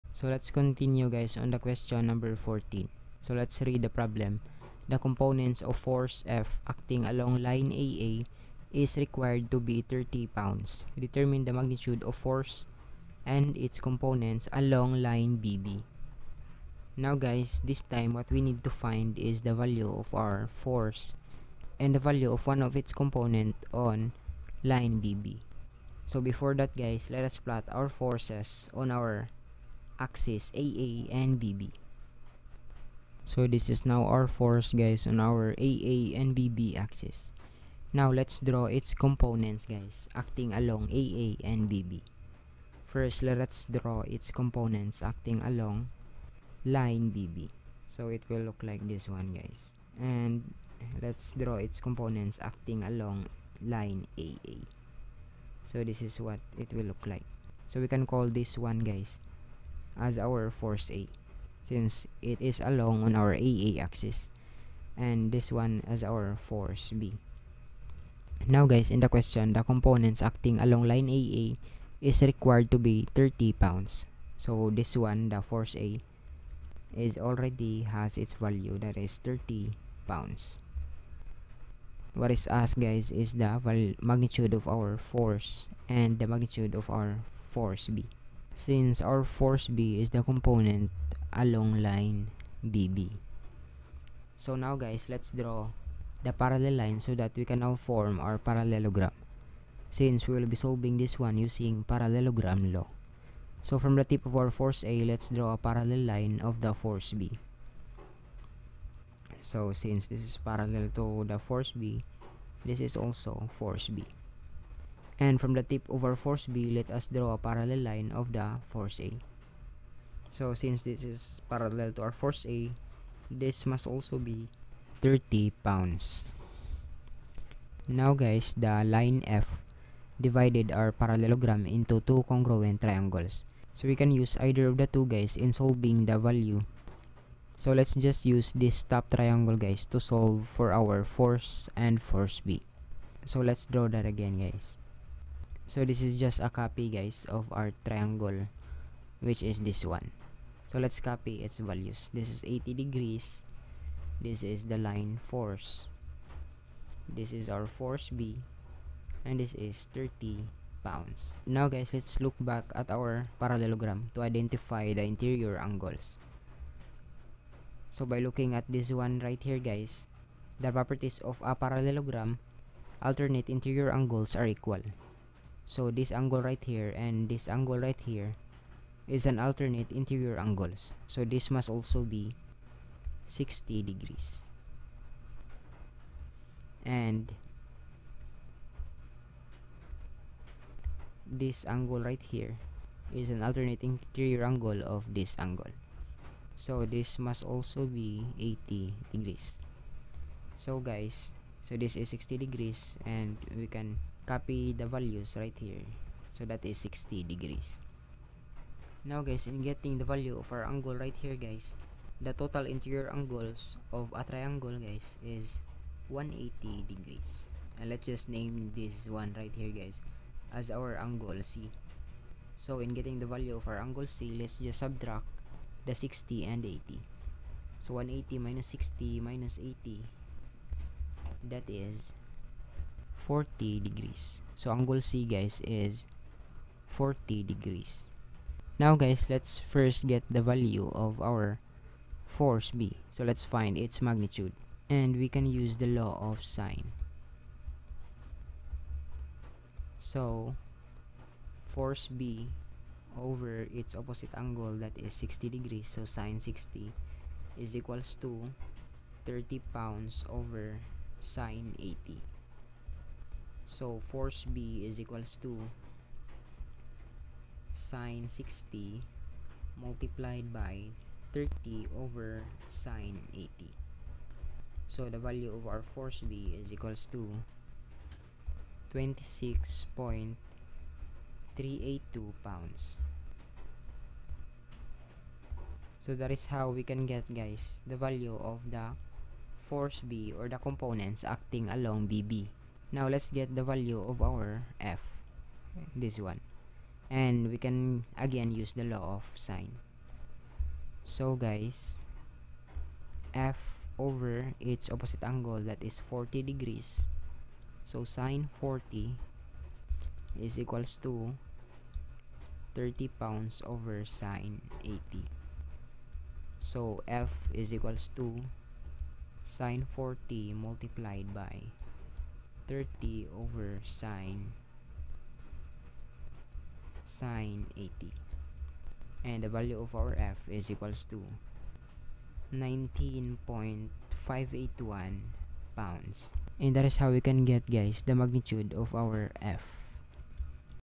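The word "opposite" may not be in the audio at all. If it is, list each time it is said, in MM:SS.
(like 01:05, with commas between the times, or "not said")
04:13, 05:04.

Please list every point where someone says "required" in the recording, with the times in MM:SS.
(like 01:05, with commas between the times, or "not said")
00:09, 01:12.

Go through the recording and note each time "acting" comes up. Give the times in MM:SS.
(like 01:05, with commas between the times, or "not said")
00:06, 00:40, 00:45, 00:52, 01:10, 04:51.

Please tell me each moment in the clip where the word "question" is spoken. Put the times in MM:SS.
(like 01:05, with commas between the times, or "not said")
00:01, 01:09.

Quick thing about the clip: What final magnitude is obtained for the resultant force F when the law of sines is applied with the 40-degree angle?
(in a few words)
19.581 pounds.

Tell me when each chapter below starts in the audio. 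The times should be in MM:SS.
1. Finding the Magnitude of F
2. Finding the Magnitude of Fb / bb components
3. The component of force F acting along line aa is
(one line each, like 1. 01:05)
1. 05:00
2. 04:19
3. 00:10.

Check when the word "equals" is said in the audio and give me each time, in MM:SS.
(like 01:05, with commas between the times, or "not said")
02:54, 04:17, 04:24, 04:36, 05:10, 05:17, 05:30.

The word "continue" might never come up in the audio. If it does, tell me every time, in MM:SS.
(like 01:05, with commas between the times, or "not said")
00:00.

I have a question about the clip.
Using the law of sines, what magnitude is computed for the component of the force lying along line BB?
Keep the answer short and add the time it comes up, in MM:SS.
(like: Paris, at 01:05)
26.382 pounds, at 04:38.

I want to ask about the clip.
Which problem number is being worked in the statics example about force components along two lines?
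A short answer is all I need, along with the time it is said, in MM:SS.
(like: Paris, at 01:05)
14, at 00:01.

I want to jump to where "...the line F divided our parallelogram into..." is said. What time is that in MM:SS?
02:08.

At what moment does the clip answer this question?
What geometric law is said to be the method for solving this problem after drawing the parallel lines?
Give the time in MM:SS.
01:41.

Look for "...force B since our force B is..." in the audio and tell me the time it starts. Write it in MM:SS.
01:27.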